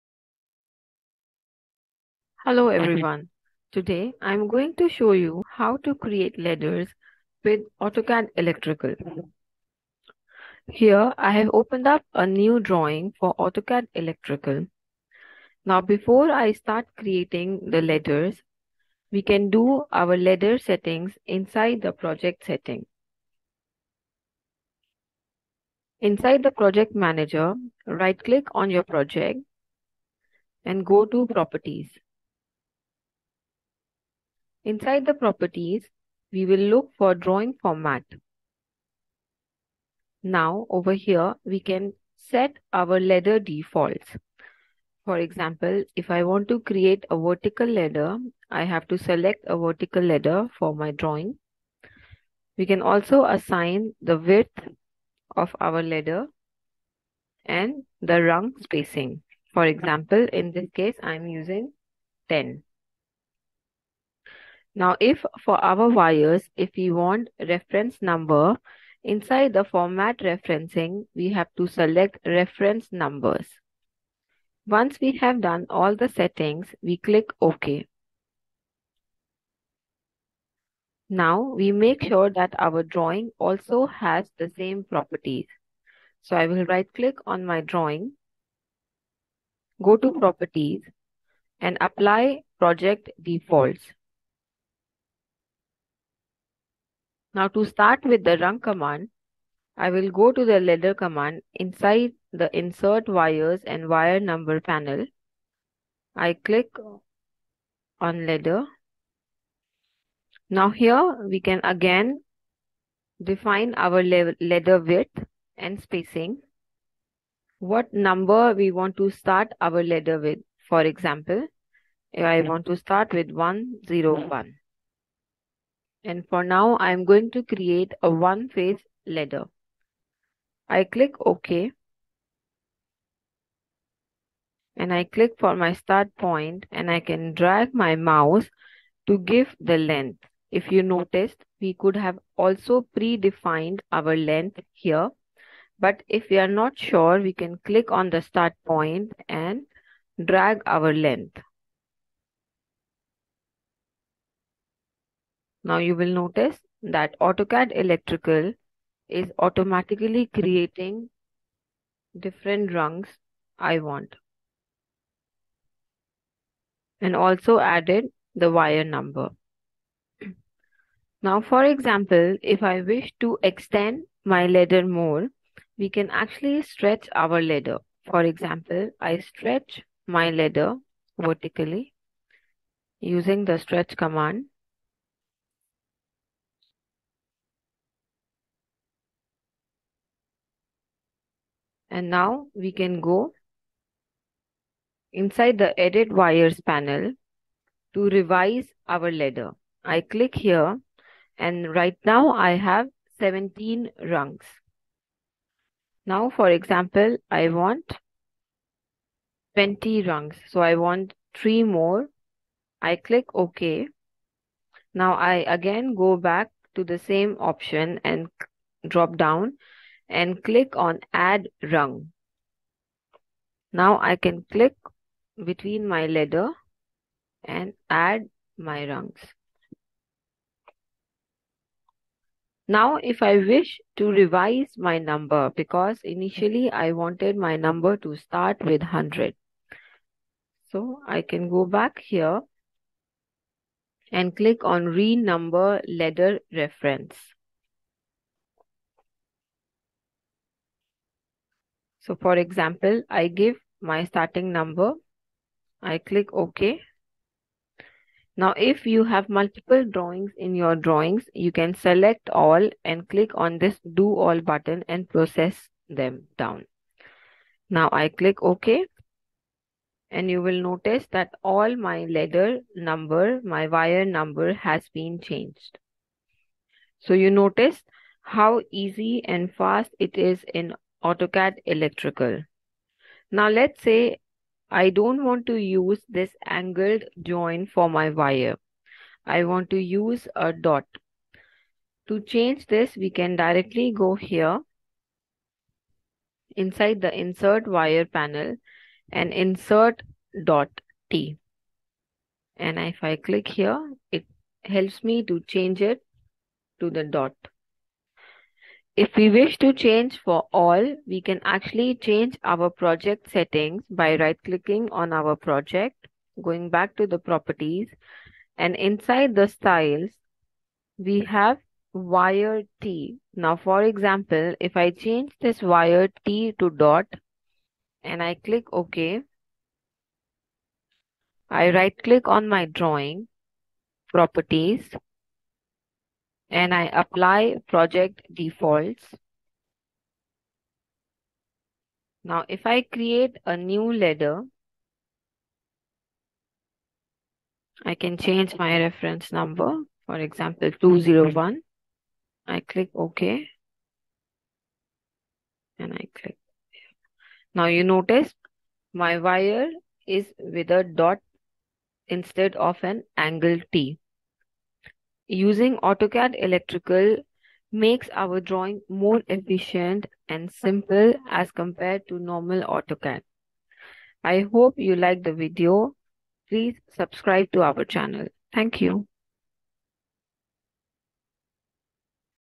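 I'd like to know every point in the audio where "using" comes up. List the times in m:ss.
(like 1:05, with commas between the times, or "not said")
1:01, 3:03, 6:05.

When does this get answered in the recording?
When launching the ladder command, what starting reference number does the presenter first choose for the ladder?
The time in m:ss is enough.
2:03.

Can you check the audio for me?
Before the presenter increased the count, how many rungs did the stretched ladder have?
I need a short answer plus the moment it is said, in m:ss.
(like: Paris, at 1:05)
17, at 3:23.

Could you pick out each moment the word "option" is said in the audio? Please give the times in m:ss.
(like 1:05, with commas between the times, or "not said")
3:37.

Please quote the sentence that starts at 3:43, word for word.
Now I can click between my ladder and add my rungs.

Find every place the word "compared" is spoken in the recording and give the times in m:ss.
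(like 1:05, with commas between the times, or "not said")
6:11.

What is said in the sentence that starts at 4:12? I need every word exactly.
So for example, I give my starting number.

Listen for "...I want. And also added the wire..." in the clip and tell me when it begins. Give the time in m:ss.
2:43.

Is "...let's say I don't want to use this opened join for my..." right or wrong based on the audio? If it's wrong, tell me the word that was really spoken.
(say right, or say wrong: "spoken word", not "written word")
wrong: "angled", not "opened".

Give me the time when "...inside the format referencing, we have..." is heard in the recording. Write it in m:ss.
1:09.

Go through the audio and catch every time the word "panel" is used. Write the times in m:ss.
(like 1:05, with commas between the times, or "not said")
1:44, 3:16, 4:58.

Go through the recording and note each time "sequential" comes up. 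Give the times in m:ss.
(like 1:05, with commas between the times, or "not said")
not said.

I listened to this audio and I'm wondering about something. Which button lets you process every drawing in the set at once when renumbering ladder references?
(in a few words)
do all.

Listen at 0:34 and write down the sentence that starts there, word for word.
Inside the properties, we will look for drawing format.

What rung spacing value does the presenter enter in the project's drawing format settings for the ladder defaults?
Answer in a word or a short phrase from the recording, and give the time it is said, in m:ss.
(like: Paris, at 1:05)
10, at 1:02.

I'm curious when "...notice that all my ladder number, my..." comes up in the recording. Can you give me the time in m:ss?
4:30.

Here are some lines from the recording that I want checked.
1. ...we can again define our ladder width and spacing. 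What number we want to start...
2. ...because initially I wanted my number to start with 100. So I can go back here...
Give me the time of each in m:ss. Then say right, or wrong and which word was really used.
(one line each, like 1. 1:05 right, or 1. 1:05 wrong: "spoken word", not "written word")
1. 1:51 right
2. 3:55 right.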